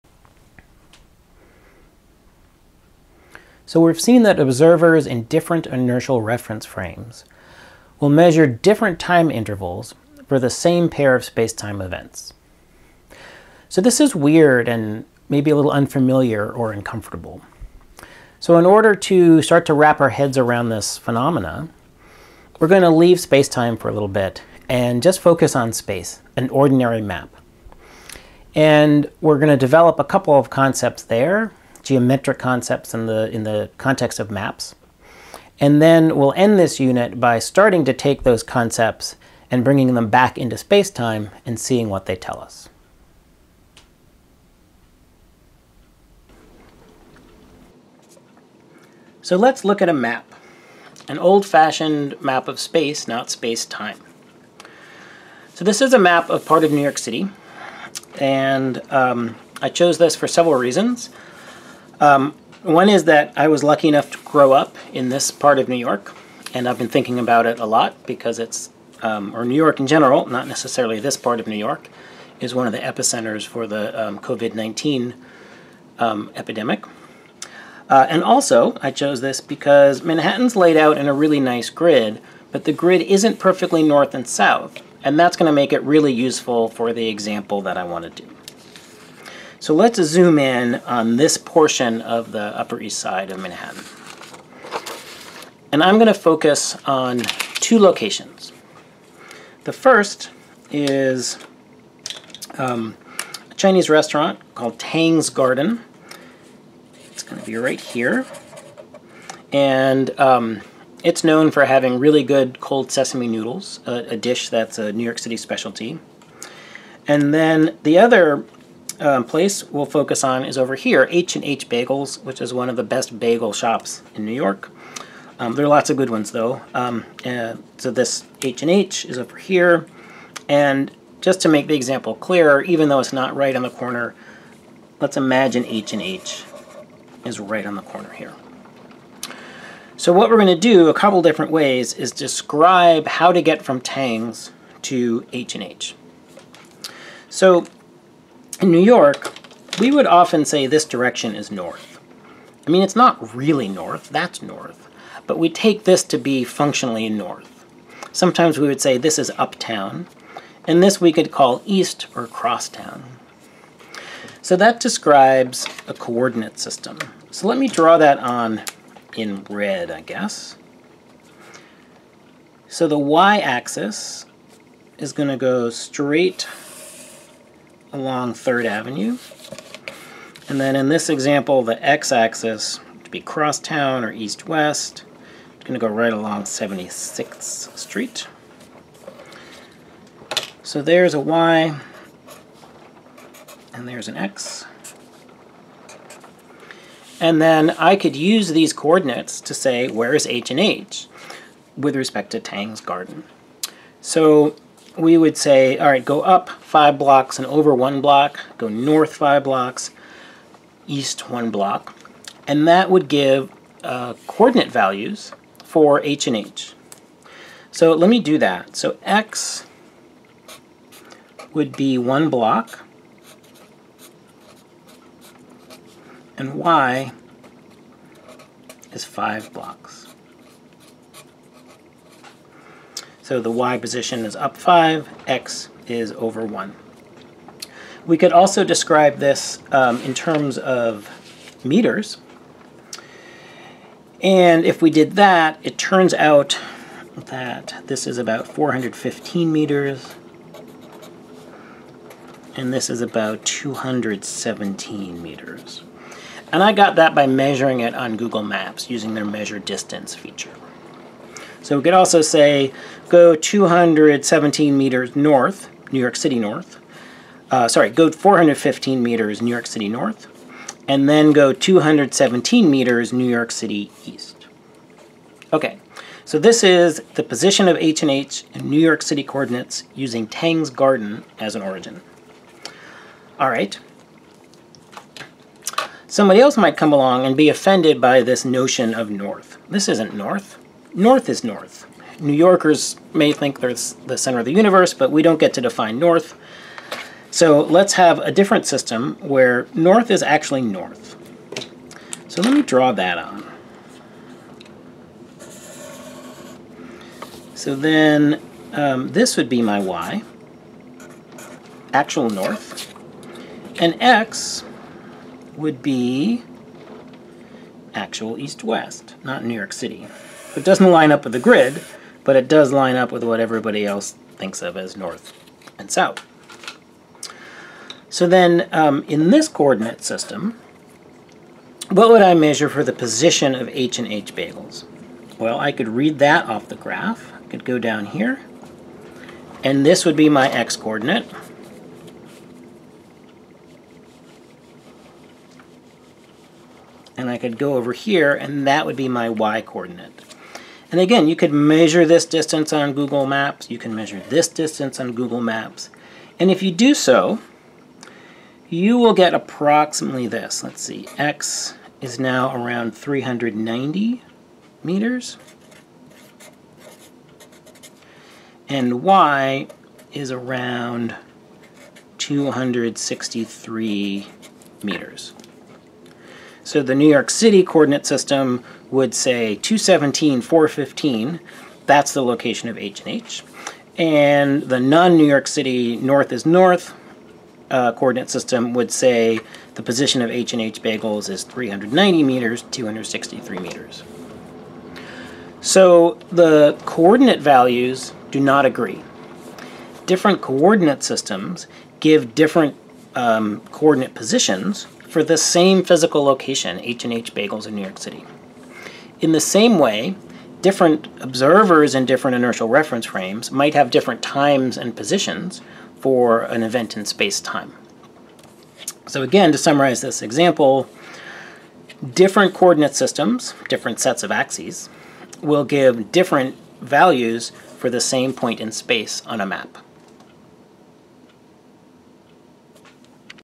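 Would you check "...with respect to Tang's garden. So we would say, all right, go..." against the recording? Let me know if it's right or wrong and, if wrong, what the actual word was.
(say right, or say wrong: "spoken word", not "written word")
right.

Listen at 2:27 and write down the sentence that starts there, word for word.
So in New York, we would often say this direction is north.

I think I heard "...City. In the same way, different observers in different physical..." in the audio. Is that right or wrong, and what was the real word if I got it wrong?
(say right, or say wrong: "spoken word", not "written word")
wrong: "inertial", not "physical".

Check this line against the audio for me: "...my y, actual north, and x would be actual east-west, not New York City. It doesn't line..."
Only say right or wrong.
right.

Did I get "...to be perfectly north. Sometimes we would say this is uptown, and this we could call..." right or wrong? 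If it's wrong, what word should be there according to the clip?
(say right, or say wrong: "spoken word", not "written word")
wrong: "functionally", not "perfectly".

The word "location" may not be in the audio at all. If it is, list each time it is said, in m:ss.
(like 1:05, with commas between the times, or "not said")
1:37, 6:22, 6:46.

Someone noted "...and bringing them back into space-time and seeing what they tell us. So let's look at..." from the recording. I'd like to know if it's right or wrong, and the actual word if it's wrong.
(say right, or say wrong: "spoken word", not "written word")
right.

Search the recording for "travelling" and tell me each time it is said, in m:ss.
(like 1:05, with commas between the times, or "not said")
not said.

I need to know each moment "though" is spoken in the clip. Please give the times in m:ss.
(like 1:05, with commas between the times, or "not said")
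2:06, 2:12.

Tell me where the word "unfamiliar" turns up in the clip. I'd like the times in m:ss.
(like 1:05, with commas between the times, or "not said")
0:15.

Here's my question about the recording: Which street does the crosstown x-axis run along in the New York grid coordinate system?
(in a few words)
76th Street.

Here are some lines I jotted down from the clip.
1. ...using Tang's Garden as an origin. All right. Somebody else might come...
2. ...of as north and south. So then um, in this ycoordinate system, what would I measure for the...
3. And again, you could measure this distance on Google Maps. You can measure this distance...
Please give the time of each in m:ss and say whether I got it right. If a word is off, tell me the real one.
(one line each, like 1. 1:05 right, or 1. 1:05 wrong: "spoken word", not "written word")
1. 4:39 right
2. 5:24 wrong: "coordinate", not "ycoordinate"
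3. 5:50 right.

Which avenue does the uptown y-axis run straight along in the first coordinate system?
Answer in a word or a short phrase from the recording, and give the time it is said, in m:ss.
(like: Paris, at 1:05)
3rd Avenue, at 2:58.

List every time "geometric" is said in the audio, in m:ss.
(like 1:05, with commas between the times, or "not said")
0:31.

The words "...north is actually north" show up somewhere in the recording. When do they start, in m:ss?
4:59.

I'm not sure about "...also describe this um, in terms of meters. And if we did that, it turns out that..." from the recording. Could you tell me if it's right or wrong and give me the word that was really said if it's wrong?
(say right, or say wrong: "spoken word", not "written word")
right.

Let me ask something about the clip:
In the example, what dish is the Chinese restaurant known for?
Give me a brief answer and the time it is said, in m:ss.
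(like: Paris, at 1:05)
Cold sesame noodles, at 1:52.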